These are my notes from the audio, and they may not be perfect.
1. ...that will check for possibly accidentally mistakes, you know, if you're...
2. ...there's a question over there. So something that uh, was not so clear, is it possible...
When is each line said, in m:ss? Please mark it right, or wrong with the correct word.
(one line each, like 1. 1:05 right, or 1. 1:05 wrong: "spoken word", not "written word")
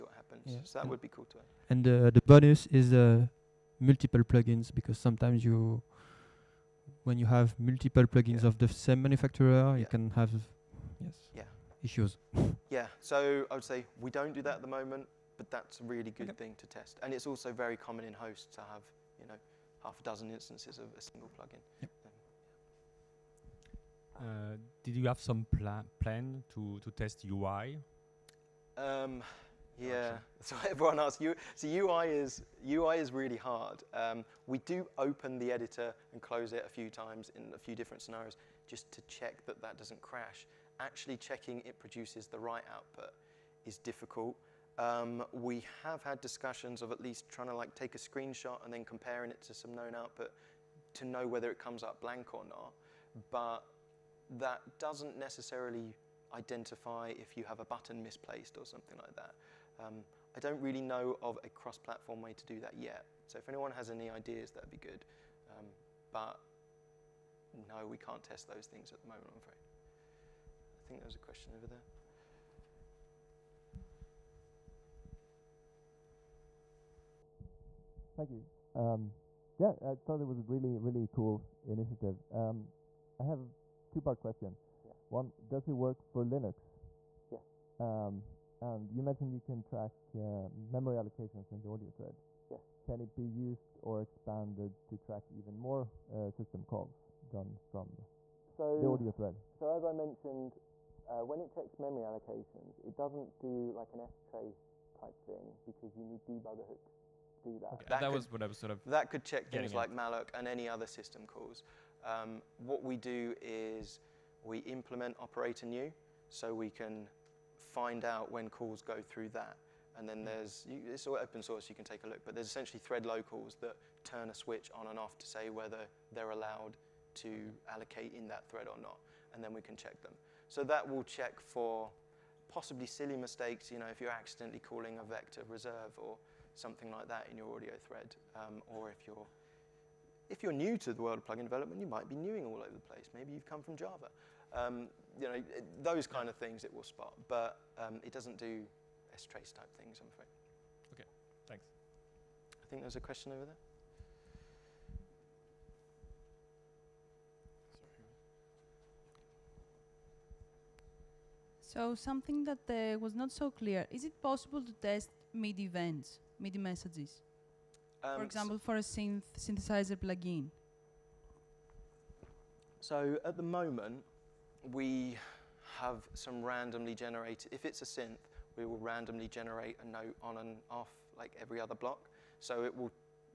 1. 2:10 wrong: "silly", not "accidentally"
2. 2:32 right.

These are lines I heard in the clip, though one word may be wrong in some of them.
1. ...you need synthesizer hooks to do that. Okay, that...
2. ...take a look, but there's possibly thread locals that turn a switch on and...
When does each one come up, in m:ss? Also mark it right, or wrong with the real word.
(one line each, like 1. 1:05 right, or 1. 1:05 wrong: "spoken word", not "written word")
1. 1:45 wrong: "debugger", not "synthesizer"
2. 2:01 wrong: "essentially", not "possibly".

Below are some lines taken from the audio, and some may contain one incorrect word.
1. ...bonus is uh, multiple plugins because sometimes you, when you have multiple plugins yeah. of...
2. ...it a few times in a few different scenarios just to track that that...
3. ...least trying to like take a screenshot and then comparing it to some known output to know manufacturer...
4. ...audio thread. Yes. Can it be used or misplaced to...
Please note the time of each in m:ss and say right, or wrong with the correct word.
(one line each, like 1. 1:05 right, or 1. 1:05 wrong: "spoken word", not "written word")
1. 0:02 right
2. 0:36 wrong: "check", not "track"
3. 0:47 wrong: "whether", not "manufacturer"
4. 1:31 wrong: "expanded", not "misplaced".